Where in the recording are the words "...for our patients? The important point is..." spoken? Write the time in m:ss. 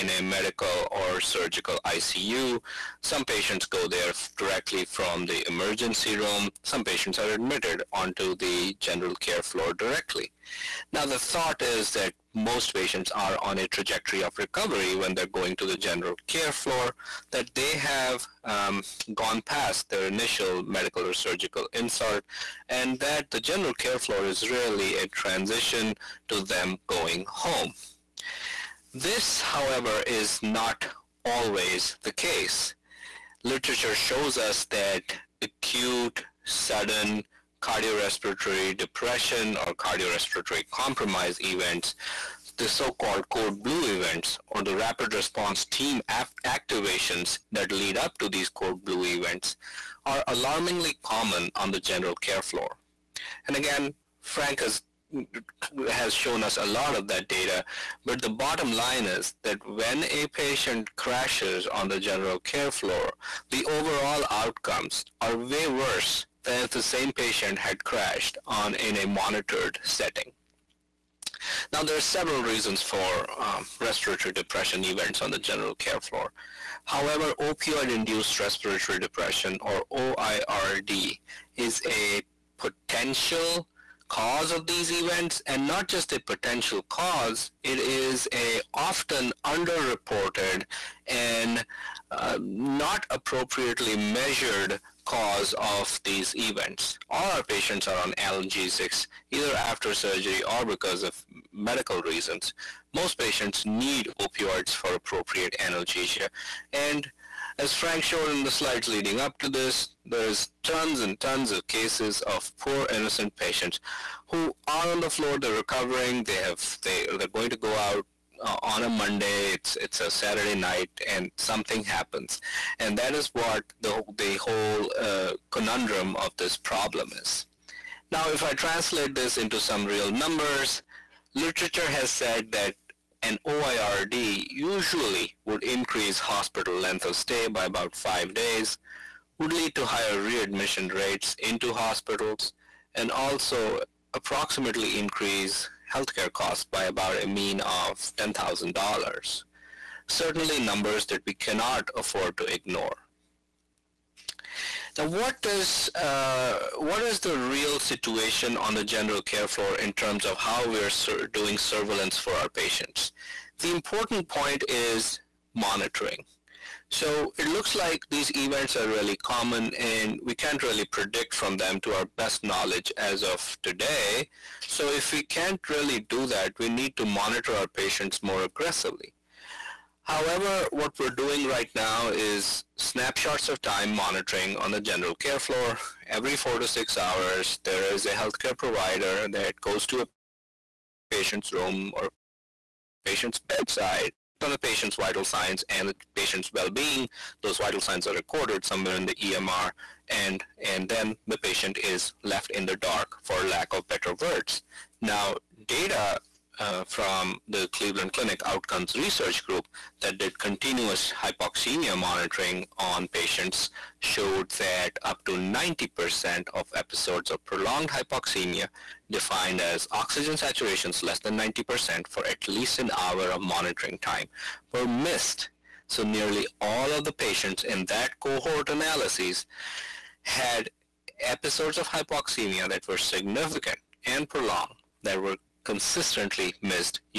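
2:42.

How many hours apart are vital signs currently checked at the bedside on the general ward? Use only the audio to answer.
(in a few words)
4 to 6.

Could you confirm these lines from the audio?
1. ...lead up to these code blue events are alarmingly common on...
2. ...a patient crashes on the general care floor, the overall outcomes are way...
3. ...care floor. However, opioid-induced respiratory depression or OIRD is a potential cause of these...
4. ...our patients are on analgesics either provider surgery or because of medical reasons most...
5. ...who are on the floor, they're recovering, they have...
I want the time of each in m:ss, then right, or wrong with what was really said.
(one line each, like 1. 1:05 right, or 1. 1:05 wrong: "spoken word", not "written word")
1. 0:47 right
2. 1:00 right
3. 1:15 right
4. 1:37 wrong: "after", not "provider"
5. 1:54 right.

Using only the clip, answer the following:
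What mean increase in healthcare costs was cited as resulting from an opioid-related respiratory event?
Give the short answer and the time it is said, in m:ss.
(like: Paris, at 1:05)
$10,000, at 2:28.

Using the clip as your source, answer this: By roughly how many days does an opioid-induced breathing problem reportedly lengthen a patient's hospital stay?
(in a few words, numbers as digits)
5.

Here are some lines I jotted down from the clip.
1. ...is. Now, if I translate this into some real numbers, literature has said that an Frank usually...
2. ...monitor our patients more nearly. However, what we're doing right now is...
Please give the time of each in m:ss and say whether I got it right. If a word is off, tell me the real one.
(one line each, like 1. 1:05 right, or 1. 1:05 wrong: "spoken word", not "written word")
1. 2:07 wrong: "OIRD", not "Frank"
2. 2:57 wrong: "aggressively", not "nearly".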